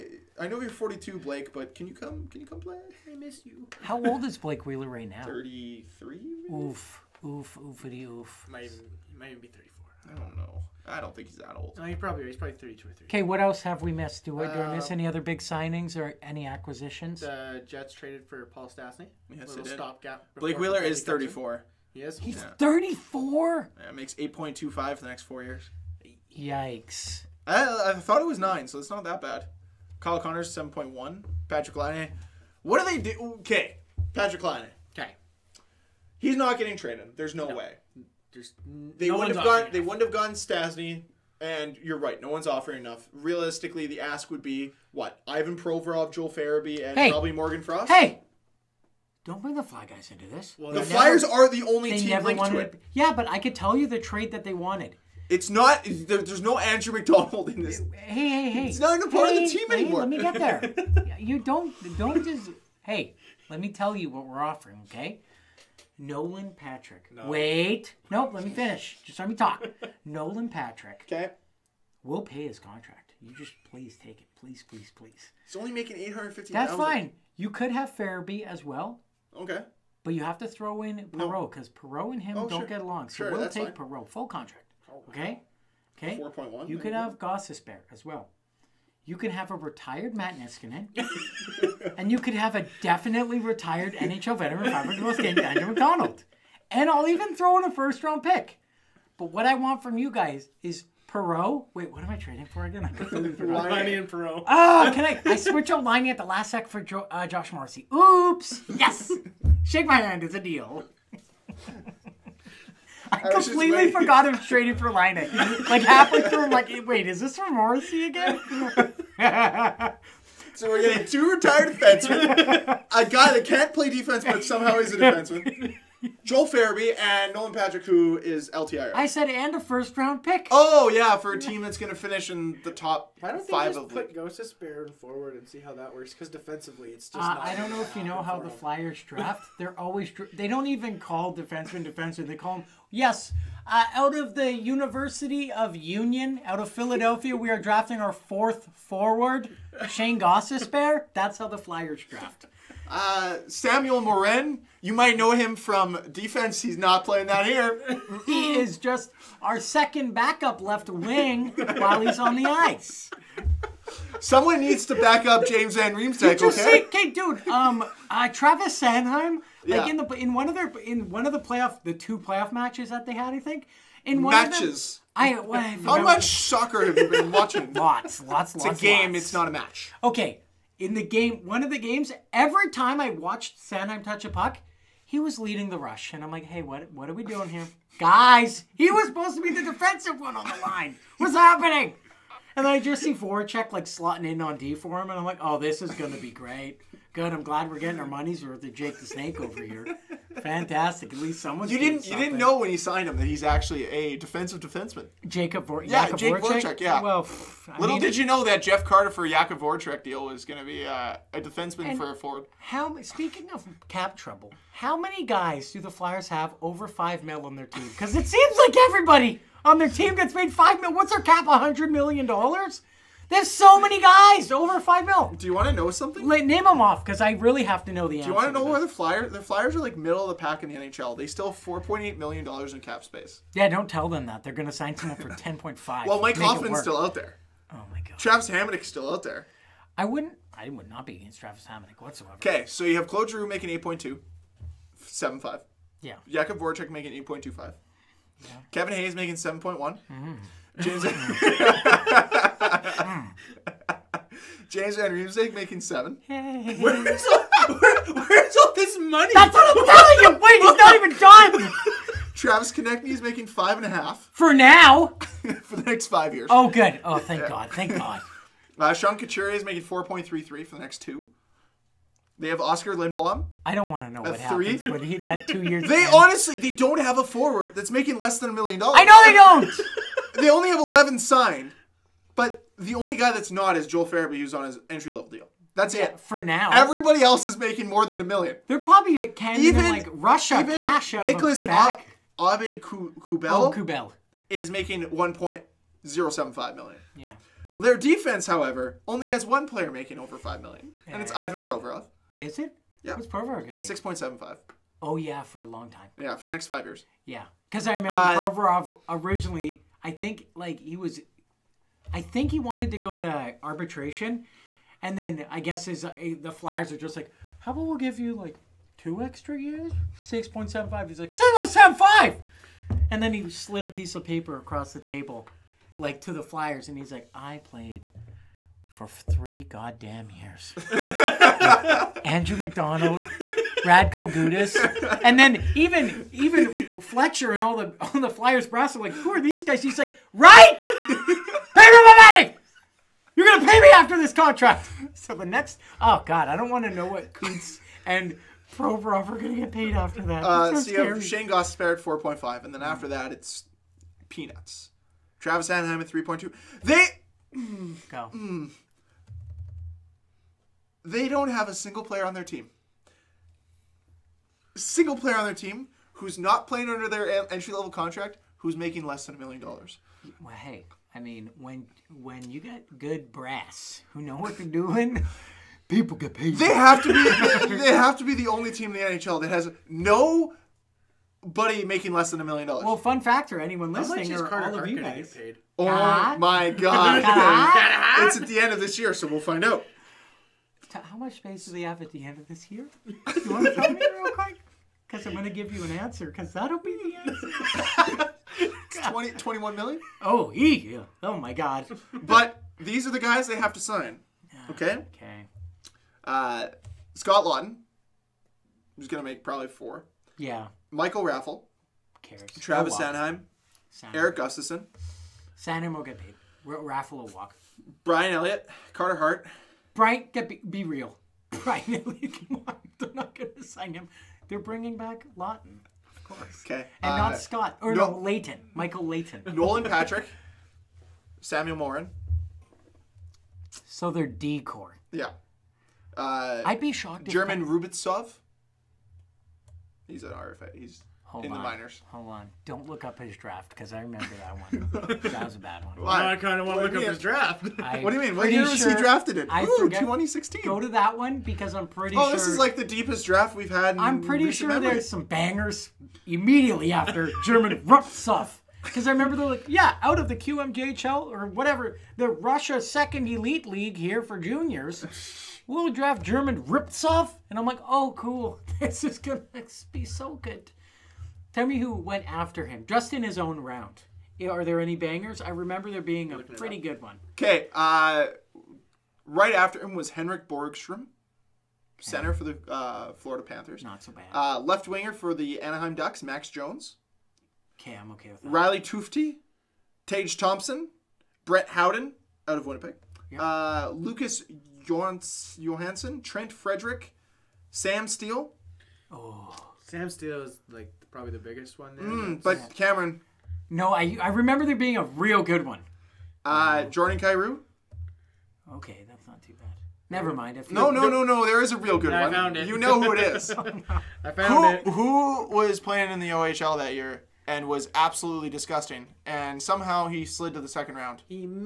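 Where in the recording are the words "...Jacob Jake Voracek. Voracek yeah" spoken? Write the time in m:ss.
3:26.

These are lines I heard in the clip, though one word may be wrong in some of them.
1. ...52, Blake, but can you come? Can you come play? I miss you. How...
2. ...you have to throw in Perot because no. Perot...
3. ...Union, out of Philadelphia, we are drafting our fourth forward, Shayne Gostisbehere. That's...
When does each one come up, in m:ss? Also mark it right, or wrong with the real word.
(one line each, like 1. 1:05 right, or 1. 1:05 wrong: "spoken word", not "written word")
1. 0:00 wrong: "42", not "52"
2. 1:20 right
3. 2:25 right.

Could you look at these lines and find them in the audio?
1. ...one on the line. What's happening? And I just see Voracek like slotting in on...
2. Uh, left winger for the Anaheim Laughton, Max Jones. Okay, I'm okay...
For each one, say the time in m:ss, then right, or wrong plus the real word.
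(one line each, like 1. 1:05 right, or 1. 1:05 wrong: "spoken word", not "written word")
1. 3:10 right
2. 8:04 wrong: "Ducks", not "Laughton".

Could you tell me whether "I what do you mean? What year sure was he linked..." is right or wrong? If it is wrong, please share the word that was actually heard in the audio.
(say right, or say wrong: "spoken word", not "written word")
wrong: "drafted", not "linked".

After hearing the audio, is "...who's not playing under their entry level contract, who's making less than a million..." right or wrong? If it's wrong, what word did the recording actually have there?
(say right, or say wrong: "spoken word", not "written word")
right.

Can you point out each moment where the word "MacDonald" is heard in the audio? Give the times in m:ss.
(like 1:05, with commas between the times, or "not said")
0:56, 1:35, 5:32.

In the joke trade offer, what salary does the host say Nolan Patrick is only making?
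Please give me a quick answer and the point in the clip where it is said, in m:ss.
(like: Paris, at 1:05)
850,000, at 1:15.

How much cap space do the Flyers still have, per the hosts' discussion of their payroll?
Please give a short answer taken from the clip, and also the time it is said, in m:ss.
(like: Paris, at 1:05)
4.8 million, at 3:51.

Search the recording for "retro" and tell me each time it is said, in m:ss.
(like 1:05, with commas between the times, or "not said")
not said.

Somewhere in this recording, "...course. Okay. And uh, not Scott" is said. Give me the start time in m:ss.
7:06.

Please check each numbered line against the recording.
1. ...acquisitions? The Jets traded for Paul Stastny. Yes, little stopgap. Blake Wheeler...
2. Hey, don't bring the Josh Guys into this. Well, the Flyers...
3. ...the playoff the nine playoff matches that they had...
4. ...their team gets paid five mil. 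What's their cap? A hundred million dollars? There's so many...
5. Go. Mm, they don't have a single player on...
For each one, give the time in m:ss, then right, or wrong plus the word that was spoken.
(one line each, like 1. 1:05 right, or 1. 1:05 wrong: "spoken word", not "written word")
1. 0:16 right
2. 0:47 wrong: "Fly", not "Josh"
3. 2:51 wrong: "two", not "nine"
4. 3:39 right
5. 5:58 right.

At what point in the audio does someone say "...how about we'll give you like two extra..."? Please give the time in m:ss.
5:17.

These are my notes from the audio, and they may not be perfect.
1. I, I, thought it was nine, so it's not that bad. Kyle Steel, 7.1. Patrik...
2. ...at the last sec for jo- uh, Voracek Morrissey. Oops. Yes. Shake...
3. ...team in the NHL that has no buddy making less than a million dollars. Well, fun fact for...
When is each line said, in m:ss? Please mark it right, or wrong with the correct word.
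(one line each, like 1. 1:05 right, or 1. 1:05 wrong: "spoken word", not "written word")
1. 0:27 wrong: "Connors", not "Steel"
2. 1:46 wrong: "Josh", not "Voracek"
3. 6:18 right.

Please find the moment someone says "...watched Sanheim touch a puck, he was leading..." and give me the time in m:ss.
3:03.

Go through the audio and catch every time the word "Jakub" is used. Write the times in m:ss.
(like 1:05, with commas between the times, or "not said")
3:29, 4:06.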